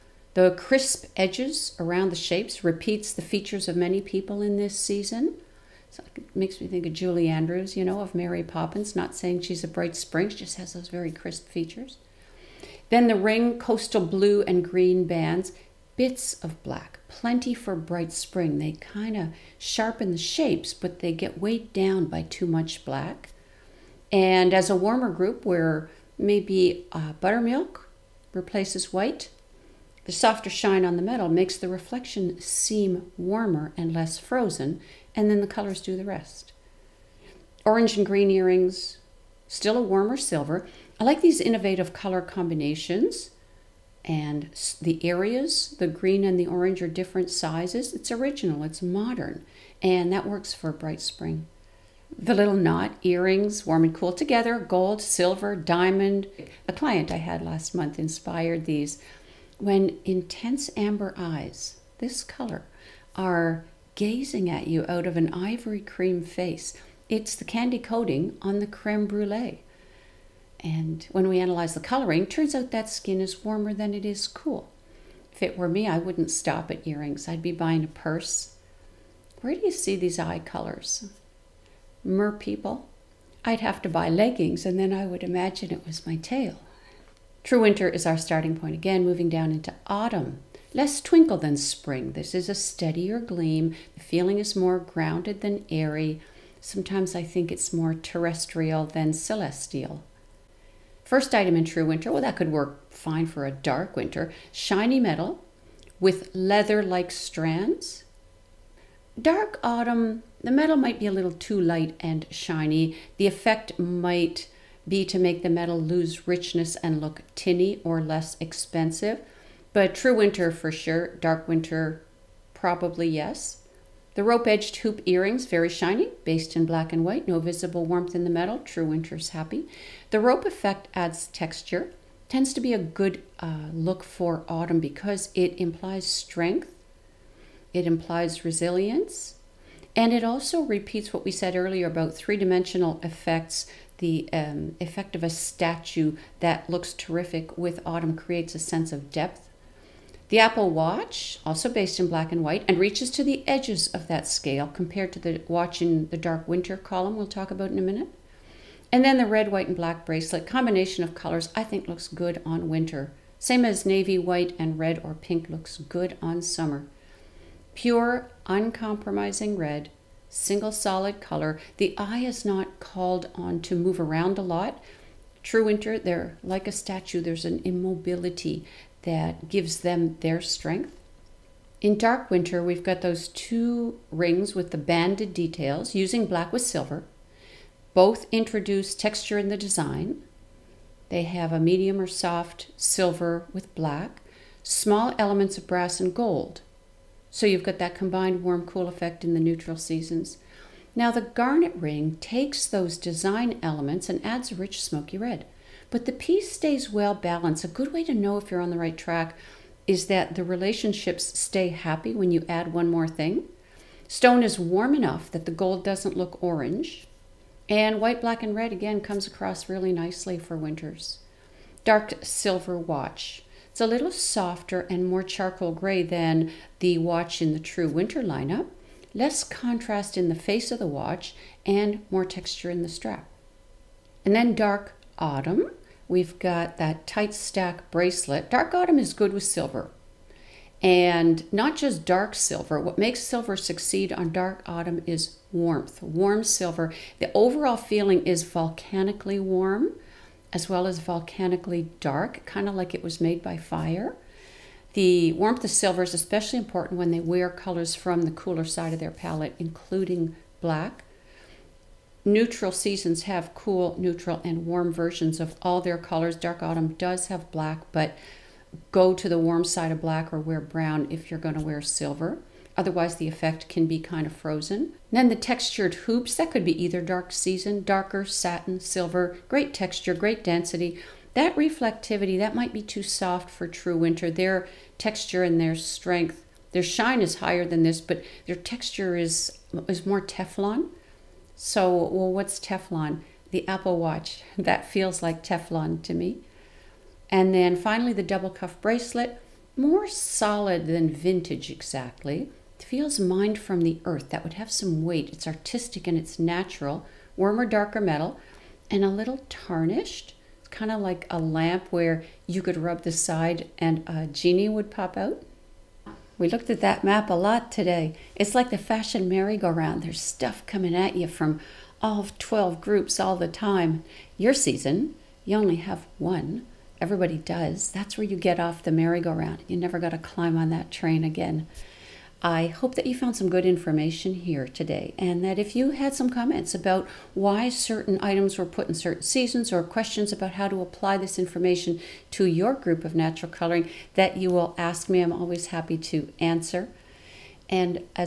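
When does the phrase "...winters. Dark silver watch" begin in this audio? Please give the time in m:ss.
3:40.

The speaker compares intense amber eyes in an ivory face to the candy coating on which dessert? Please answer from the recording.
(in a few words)
creme brulee.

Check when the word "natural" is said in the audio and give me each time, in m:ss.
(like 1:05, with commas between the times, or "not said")
5:06, 5:43.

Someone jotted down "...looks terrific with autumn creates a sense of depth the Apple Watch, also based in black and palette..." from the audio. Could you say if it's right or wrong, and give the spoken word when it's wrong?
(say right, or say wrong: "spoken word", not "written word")
wrong: "white", not "palette".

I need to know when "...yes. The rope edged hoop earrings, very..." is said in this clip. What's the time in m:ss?
2:03.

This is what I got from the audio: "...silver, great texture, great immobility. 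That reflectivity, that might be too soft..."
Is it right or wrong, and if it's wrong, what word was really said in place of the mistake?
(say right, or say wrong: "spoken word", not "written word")
wrong: "density", not "immobility".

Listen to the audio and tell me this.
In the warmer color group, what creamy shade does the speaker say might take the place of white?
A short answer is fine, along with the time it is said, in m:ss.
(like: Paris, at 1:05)
buttermilk, at 0:27.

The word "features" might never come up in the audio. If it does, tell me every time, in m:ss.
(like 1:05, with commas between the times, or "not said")
0:03, 0:11.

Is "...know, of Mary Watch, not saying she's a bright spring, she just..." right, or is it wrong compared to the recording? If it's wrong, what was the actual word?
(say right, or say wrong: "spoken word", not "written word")
wrong: "Poppins", not "Watch".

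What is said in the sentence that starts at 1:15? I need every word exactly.
If it were me, I wouldn't stop at earrings.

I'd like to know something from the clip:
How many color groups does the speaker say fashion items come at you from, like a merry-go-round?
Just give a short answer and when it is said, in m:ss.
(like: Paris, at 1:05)
12, at 5:22.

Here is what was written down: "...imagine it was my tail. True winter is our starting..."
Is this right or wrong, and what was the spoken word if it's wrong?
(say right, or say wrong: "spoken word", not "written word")
right.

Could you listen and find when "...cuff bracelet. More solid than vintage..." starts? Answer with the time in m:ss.
4:58.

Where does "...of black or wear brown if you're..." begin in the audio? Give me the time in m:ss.
4:29.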